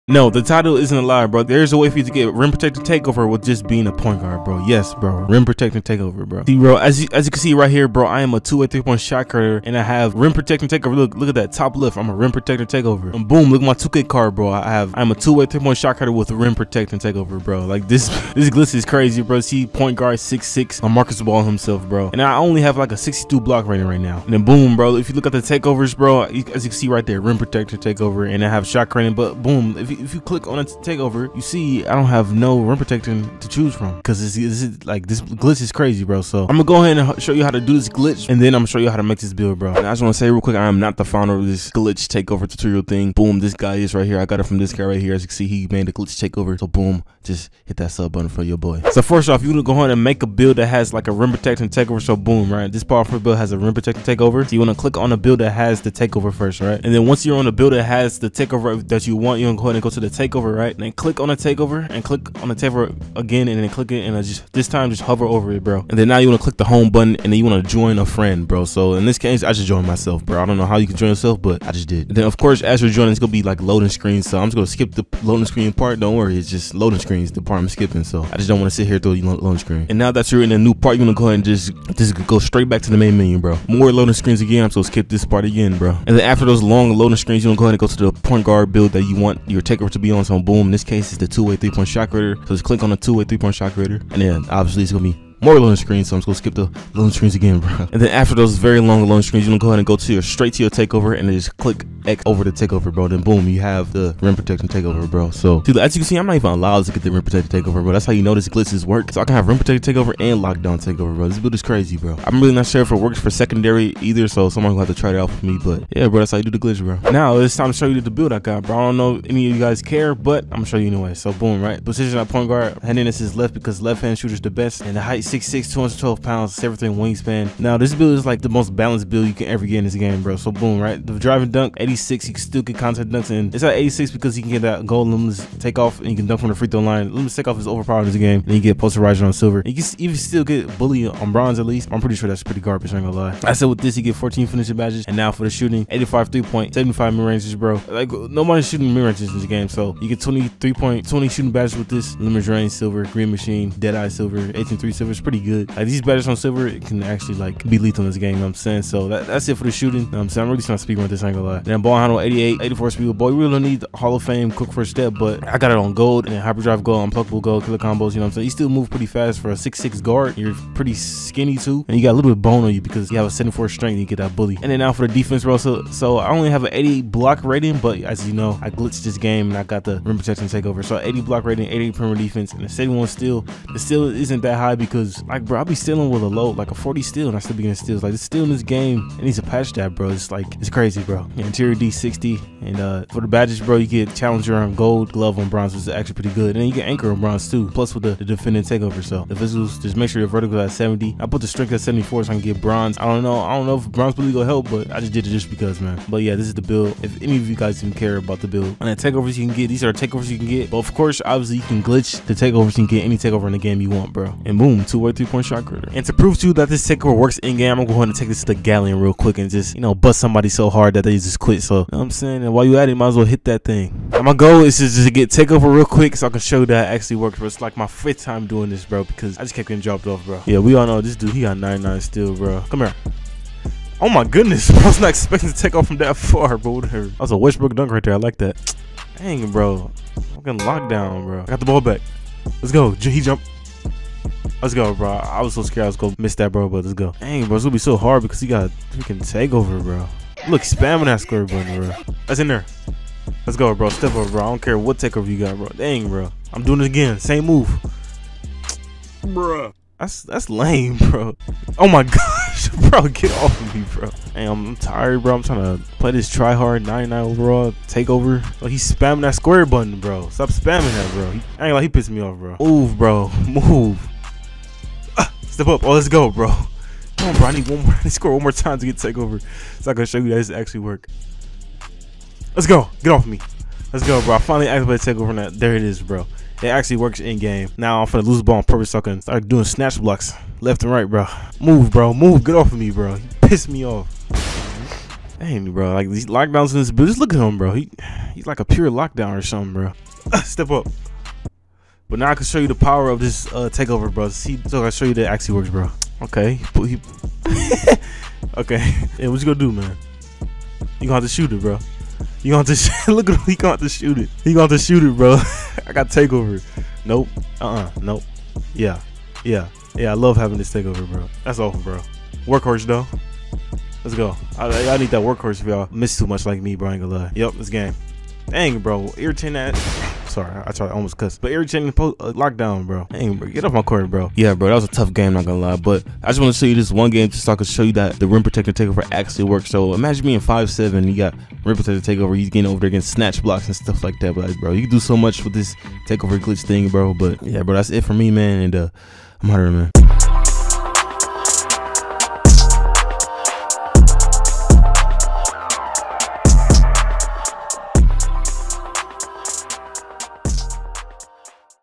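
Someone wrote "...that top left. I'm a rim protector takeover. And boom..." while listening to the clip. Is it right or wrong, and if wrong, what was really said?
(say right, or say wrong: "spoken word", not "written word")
right.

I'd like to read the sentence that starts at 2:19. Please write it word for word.
You can even still get bully on bronze at least.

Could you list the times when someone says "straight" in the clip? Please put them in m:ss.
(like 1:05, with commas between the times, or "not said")
1:22, 1:40.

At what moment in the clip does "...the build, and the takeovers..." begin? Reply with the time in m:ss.
3:28.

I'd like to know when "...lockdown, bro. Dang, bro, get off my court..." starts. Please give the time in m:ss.
5:32.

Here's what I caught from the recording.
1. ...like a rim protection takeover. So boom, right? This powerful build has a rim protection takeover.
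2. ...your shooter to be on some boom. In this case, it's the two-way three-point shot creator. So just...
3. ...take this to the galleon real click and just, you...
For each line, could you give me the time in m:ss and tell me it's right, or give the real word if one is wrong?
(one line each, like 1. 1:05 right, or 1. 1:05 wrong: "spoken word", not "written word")
1. 0:50 right
2. 1:29 wrong: "checker", not "shooter"
3. 3:38 wrong: "quick", not "click".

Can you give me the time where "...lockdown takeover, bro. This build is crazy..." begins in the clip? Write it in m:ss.
1:50.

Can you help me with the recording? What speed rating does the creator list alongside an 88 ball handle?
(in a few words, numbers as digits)
84.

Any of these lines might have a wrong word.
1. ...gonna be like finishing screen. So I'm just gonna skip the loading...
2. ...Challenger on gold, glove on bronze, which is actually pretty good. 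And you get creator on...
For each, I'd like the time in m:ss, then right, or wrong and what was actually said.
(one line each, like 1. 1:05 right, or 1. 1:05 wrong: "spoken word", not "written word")
1. 1:13 wrong: "loading", not "finishing"
2. 3:14 wrong: "anchor", not "creator".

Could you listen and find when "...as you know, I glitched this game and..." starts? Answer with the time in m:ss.
2:58.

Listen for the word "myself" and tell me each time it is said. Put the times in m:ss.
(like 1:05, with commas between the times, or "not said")
1:09.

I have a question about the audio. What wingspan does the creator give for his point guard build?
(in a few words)
7'3.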